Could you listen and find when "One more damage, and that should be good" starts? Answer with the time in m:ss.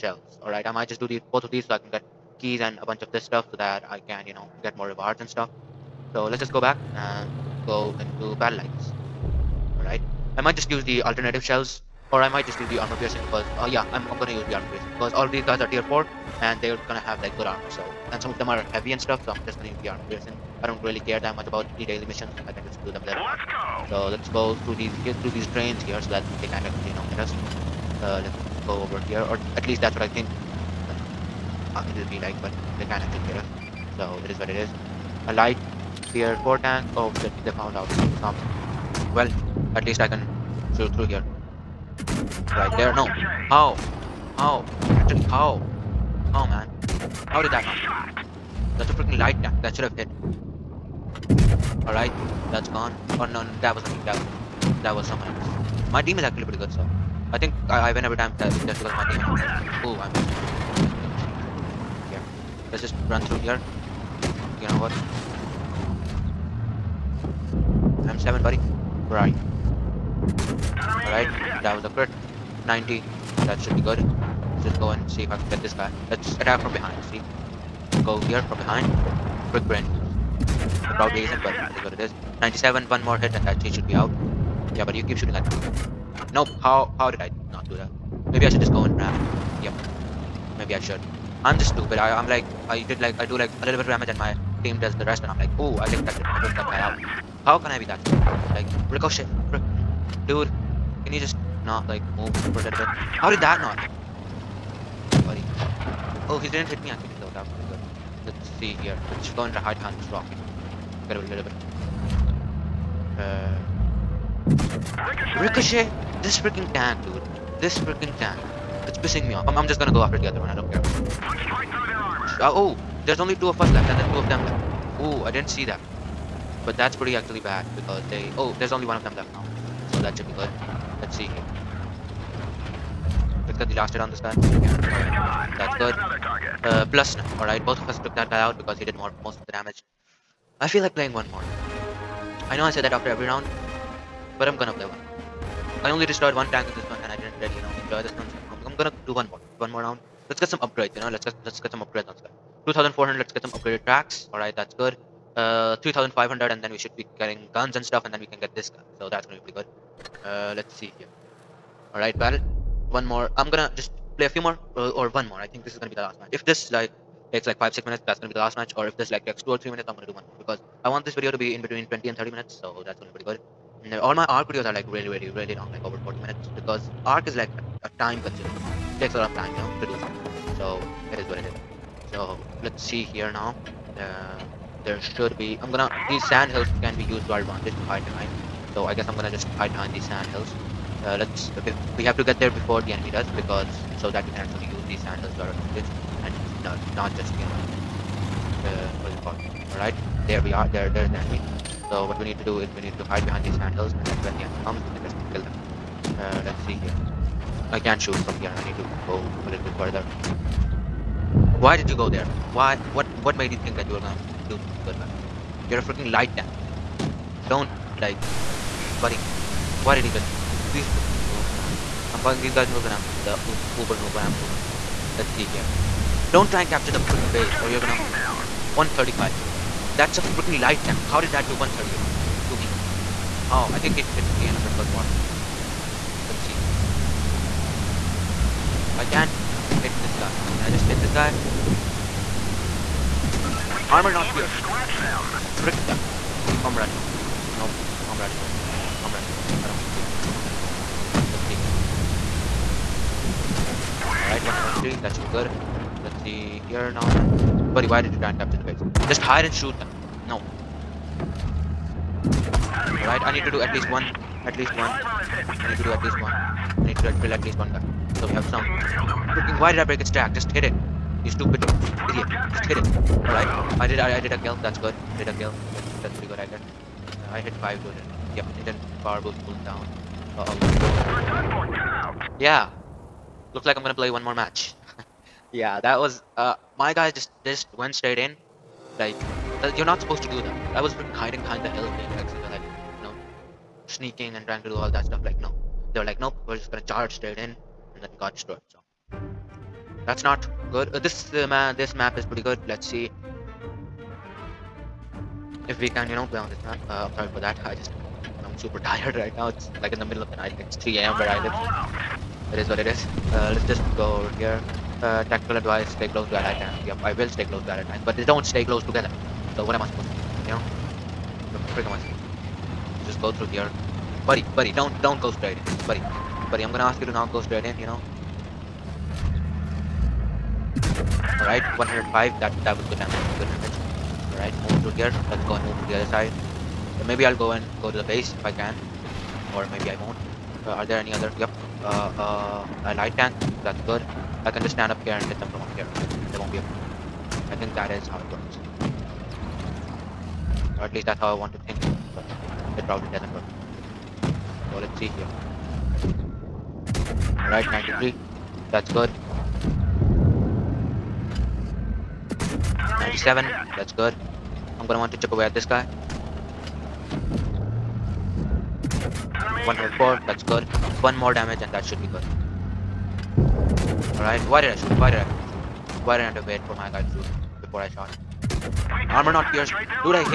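6:11.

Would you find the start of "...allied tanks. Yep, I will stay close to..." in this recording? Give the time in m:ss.
5:16.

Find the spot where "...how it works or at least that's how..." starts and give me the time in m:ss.
5:48.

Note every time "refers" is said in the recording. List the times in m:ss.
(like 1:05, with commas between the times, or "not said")
not said.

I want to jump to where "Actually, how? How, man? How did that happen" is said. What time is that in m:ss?
0:45.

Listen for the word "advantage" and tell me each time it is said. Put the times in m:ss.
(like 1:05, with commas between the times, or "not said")
3:07, 3:15.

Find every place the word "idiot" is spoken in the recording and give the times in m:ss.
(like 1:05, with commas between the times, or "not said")
4:31.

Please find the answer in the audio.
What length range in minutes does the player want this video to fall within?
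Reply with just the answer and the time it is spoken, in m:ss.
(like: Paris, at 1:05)
20 to 30 minutes, at 2:51.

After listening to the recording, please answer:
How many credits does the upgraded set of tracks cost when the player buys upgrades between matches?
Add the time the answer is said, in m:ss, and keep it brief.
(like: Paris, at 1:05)
2400, at 2:32.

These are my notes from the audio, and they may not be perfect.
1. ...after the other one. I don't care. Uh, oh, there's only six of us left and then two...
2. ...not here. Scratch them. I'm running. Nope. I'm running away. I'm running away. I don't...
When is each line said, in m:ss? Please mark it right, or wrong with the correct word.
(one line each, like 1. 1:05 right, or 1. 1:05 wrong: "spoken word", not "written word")
1. 2:00 wrong: "two", not "six"
2. 4:04 right.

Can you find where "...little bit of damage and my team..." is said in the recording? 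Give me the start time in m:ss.
1:33.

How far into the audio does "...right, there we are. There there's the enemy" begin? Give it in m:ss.
3:19.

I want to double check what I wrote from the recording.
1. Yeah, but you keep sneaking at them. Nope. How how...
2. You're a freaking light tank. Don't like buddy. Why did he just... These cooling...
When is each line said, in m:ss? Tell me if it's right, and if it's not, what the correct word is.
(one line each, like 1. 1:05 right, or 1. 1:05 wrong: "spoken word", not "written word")
1. 1:24 wrong: "shooting", not "sneaking"
2. 3:35 wrong: "freaking", not "cooling".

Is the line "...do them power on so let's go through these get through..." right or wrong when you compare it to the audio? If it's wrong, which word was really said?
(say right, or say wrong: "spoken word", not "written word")
wrong: "later", not "power".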